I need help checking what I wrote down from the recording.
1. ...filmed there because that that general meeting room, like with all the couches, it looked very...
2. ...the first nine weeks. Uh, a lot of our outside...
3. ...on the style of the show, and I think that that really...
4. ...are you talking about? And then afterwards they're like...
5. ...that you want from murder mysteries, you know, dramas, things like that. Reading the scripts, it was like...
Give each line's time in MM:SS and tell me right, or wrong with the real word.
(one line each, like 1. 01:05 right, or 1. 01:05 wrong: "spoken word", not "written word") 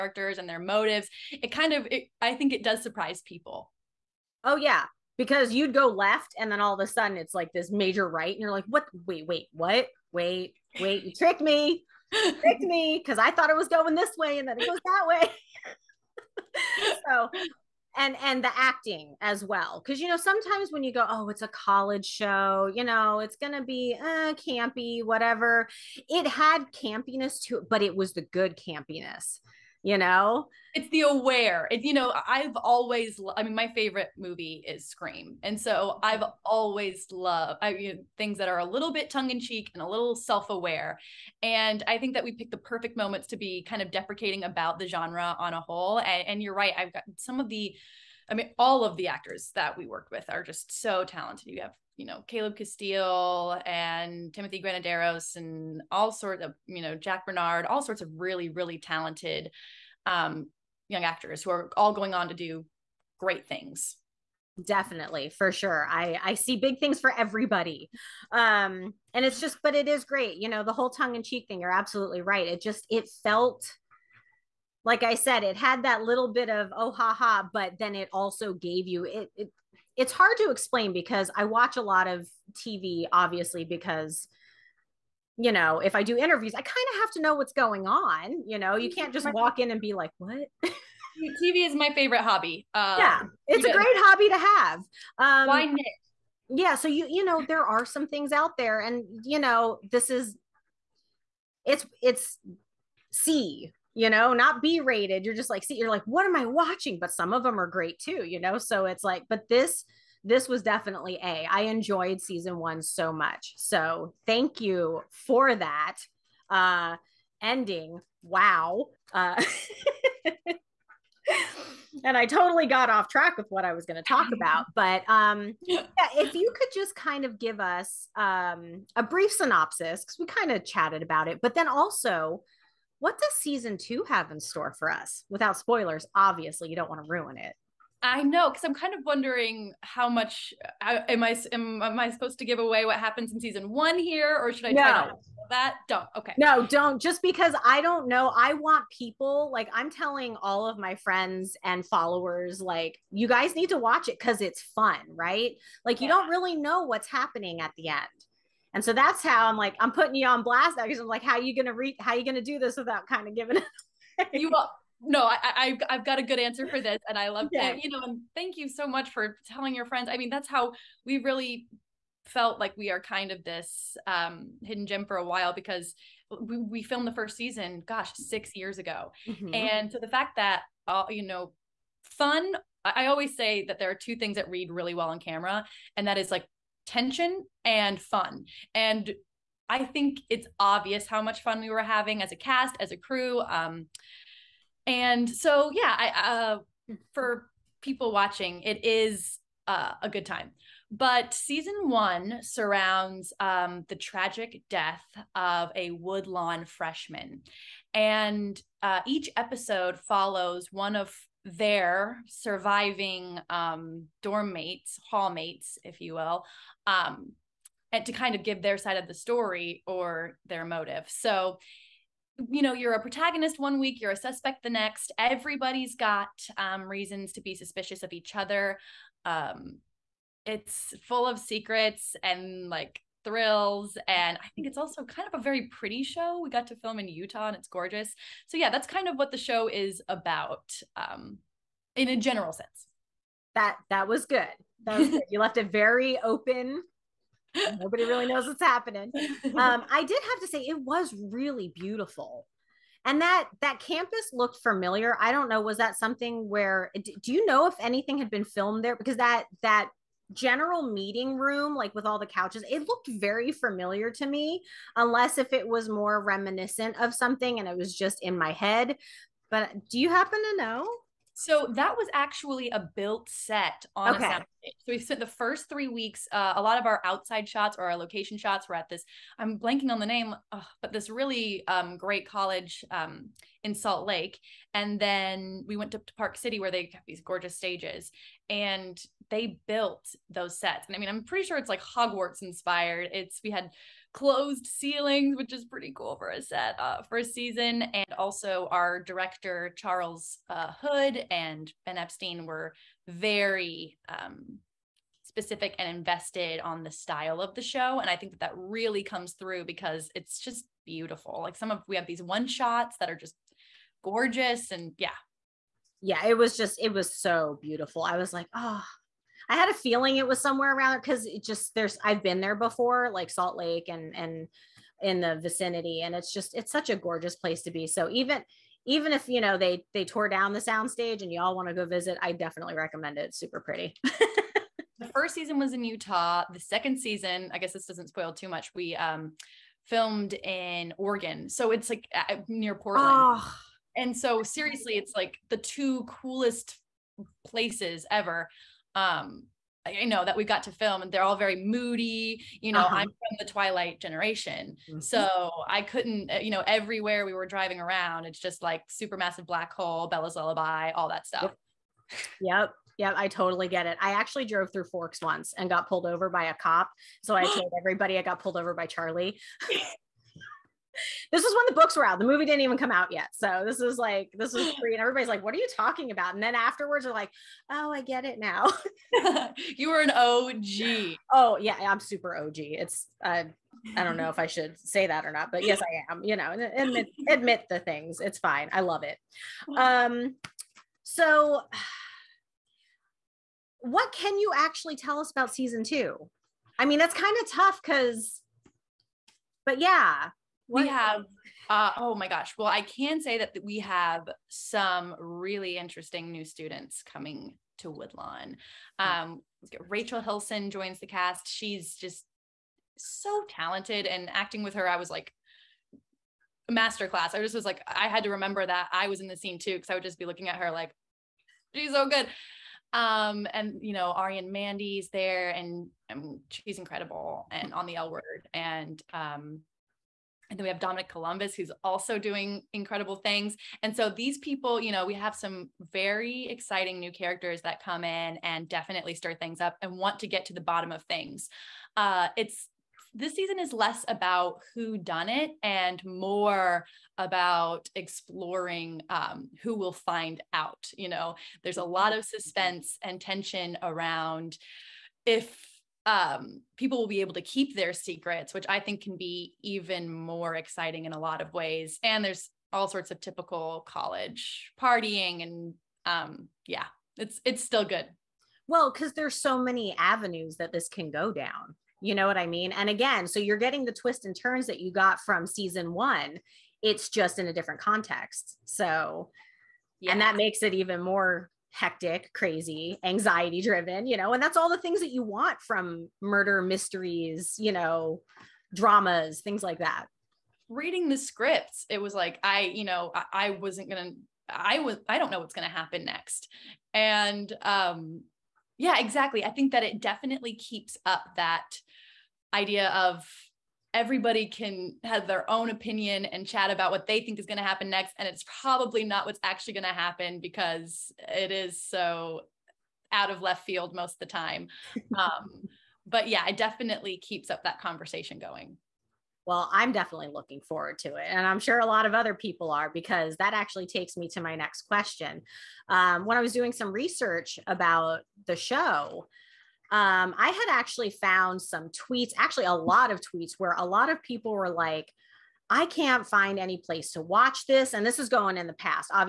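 1. 04:18 right
2. 04:35 wrong: "three", not "nine"
3. 05:06 right
4. 06:15 right
5. 08:05 right.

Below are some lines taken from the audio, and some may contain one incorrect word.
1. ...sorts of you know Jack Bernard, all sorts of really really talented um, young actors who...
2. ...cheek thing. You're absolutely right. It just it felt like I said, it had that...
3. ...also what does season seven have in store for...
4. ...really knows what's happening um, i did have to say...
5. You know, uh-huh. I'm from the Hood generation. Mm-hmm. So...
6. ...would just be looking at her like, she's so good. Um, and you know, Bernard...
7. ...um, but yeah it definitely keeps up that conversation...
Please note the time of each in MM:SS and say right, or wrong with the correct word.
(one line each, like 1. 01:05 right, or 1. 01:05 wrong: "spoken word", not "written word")
1. 00:56 right
2. 01:11 right
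3. 02:11 wrong: "two", not "seven"
4. 04:08 right
5. 05:52 wrong: "Twilight", not "Hood"
6. 06:59 wrong: "Arienne", not "Bernard"
7. 08:35 right.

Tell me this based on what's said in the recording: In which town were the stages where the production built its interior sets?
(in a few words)
Park City.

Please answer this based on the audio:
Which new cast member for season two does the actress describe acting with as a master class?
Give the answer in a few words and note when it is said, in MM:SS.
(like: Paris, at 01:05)
Rachel Hilson, at 06:49.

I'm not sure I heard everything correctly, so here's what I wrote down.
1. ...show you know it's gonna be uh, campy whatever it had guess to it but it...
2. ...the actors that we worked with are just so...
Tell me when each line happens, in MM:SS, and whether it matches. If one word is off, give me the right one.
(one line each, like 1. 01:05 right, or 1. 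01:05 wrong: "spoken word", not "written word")
1. 00:22 wrong: "campiness", not "guess"
2. 00:48 right.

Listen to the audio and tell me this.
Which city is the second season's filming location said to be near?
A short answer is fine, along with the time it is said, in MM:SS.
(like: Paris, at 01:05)
Portland, at 05:42.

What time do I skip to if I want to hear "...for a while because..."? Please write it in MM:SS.
02:55.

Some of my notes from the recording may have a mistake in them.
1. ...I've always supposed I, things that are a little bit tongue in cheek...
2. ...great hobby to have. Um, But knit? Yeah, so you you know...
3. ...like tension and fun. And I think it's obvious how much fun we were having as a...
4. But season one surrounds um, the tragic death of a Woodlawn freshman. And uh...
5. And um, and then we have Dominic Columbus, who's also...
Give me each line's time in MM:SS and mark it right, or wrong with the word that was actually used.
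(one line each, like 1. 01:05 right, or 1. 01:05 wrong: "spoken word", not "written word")
1. 00:36 wrong: "loved", not "supposed"
2. 01:33 wrong: "Why", not "But"
3. 03:06 right
4. 03:20 right
5. 07:08 right.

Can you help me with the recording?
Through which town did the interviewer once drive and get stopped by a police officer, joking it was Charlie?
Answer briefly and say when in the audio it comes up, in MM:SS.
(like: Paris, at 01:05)
Forks, at 06:04.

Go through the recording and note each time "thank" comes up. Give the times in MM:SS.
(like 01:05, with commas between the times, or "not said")
01:54, 02:48.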